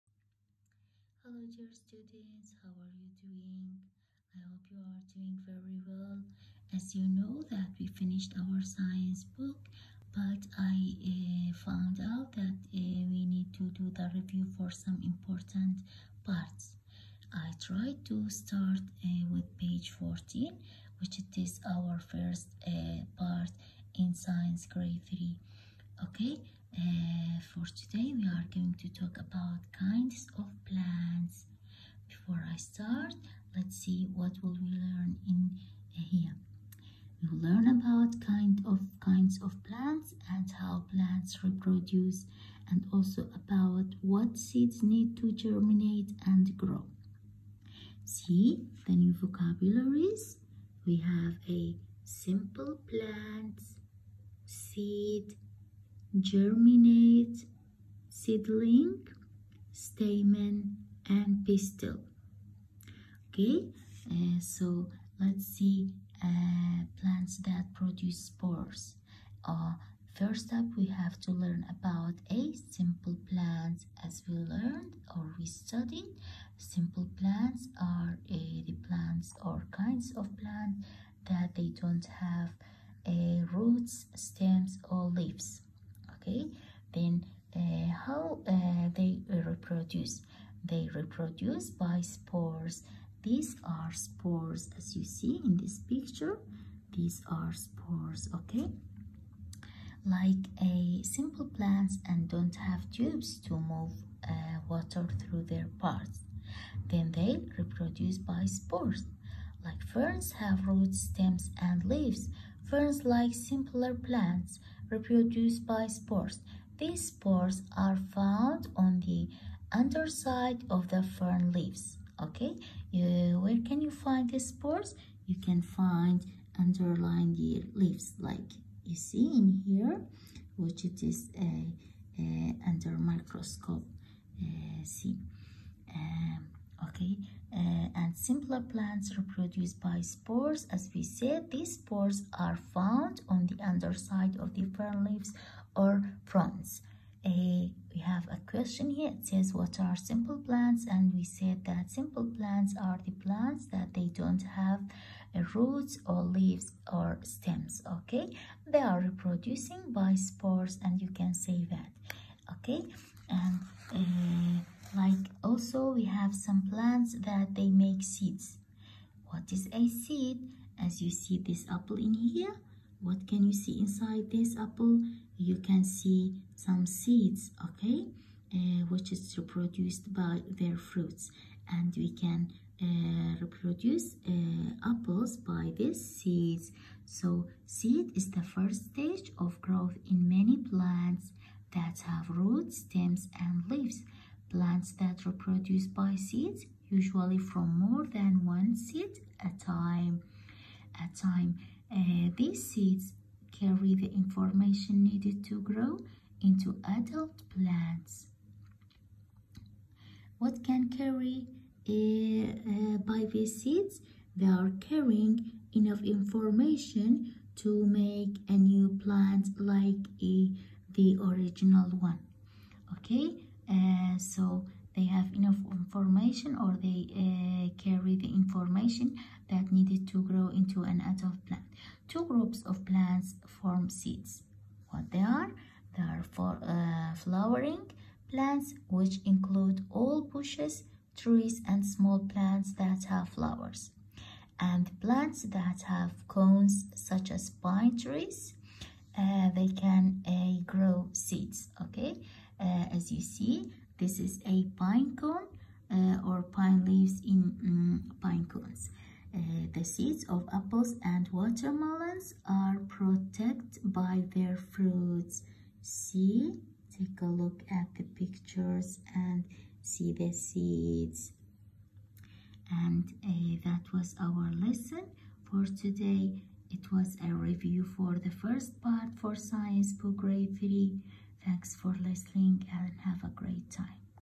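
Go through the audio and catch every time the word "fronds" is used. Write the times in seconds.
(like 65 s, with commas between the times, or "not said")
146 s.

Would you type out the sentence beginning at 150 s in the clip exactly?
And we said that simple plants are the plants that they don't have roots or leaves or stems, okay?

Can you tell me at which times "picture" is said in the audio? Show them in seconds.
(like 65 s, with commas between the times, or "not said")
95 s, 268 s.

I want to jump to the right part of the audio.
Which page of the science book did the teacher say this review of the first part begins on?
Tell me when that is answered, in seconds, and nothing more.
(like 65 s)
19 s.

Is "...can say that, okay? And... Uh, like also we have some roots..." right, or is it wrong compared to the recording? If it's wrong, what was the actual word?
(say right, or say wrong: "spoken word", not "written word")
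wrong: "plants", not "roots".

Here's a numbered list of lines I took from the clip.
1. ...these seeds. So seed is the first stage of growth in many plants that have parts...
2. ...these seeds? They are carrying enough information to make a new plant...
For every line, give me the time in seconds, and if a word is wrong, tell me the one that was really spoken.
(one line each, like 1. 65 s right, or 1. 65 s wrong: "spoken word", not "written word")
1. 185 s wrong: "roots", not "parts"
2. 213 s right.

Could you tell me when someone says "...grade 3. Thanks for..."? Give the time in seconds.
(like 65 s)
280 s.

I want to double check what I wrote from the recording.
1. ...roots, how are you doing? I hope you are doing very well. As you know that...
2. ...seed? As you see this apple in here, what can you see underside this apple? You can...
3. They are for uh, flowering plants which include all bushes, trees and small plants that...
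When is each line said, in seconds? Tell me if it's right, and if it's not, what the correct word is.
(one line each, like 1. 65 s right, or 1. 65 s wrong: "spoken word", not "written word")
1. 1 s wrong: "students", not "roots"
2. 169 s wrong: "inside", not "underside"
3. 235 s right.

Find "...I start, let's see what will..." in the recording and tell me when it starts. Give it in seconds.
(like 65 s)
32 s.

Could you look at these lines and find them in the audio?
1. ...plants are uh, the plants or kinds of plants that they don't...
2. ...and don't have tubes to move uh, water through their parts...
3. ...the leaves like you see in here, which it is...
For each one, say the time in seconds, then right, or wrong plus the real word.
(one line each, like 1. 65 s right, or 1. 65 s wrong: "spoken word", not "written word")
1. 77 s right
2. 102 s right
3. 127 s right.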